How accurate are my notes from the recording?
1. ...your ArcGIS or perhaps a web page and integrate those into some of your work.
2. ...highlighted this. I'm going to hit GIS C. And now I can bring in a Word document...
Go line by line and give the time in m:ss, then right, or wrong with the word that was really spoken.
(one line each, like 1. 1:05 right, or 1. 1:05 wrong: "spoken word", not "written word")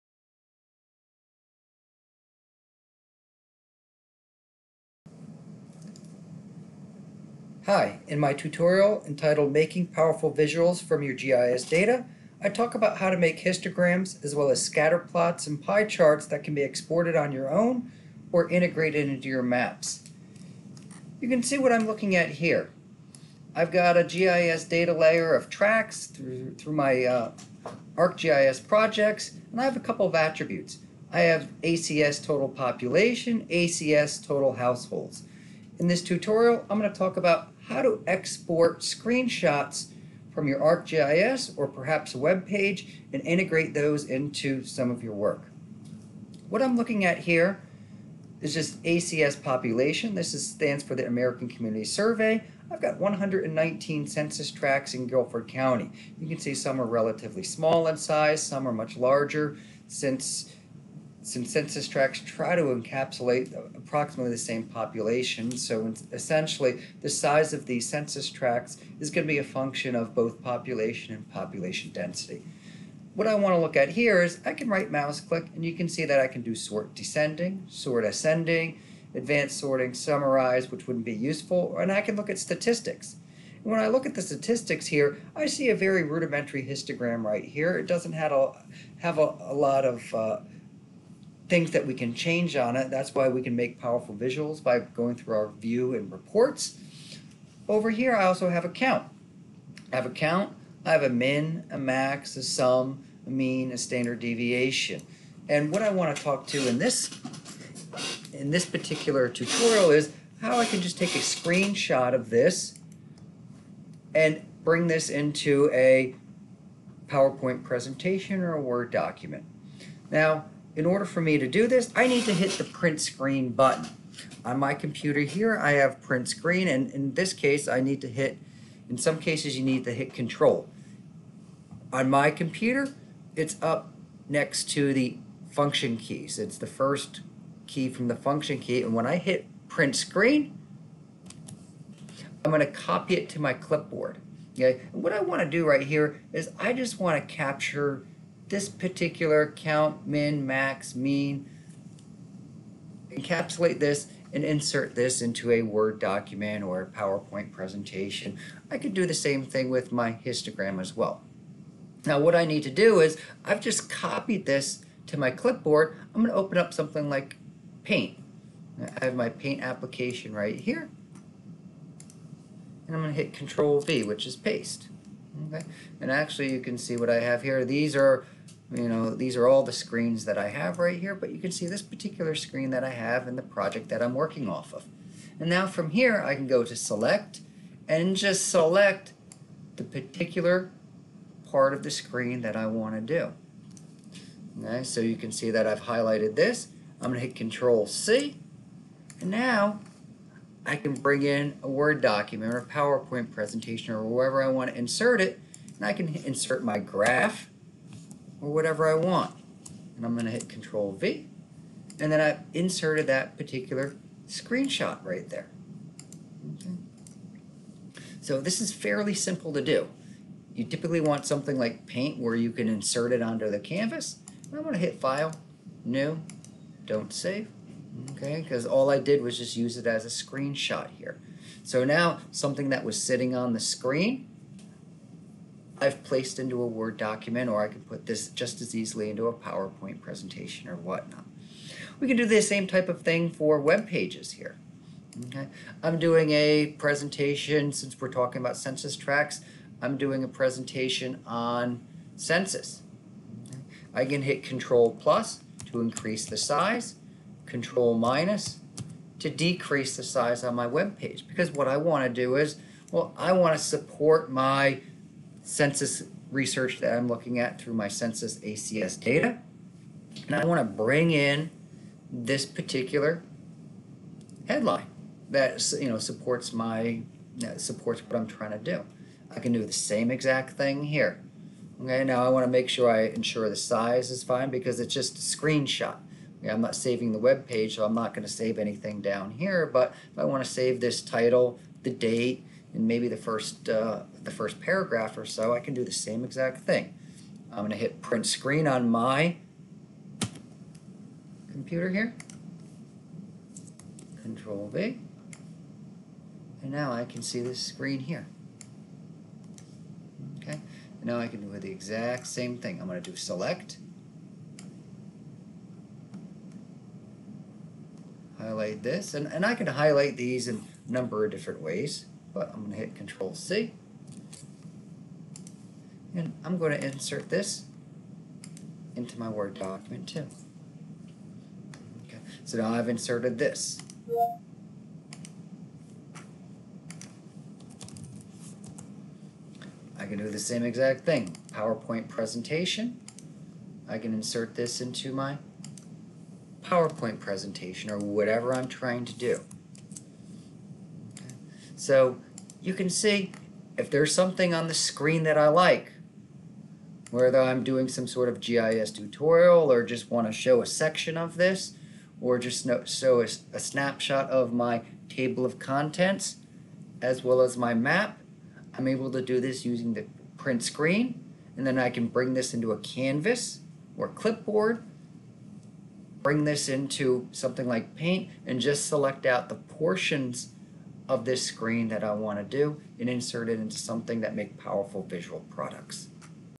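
1. 0:40 right
2. 3:15 wrong: "Control", not "GIS".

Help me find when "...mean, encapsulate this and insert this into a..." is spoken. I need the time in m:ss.
2:30.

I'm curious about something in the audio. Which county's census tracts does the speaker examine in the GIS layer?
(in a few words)
Guilford County.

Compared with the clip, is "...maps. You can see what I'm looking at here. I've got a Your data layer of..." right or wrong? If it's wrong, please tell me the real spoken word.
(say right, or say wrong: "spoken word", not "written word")
wrong: "GIS", not "Your".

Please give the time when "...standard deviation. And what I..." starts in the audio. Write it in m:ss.
1:43.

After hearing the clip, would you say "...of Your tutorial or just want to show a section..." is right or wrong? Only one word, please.
wrong.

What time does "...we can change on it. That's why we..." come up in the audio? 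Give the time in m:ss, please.
1:31.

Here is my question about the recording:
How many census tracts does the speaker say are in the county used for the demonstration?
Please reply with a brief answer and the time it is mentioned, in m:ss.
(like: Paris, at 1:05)
119, at 0:52.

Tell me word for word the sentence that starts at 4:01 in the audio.
We can do the same type of thing for web pages here.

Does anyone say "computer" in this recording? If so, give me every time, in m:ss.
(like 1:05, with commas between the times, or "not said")
2:04, 2:12, 5:01.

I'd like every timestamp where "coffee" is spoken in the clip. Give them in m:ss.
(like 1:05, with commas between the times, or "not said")
not said.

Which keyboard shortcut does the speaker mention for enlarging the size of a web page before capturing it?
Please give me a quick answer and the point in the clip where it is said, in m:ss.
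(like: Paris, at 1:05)
Control plus, at 4:14.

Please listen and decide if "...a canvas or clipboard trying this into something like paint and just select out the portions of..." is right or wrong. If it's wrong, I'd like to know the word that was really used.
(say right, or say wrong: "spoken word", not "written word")
wrong: "bring", not "trying".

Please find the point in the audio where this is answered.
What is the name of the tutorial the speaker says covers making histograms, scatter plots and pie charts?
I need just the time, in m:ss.
0:09.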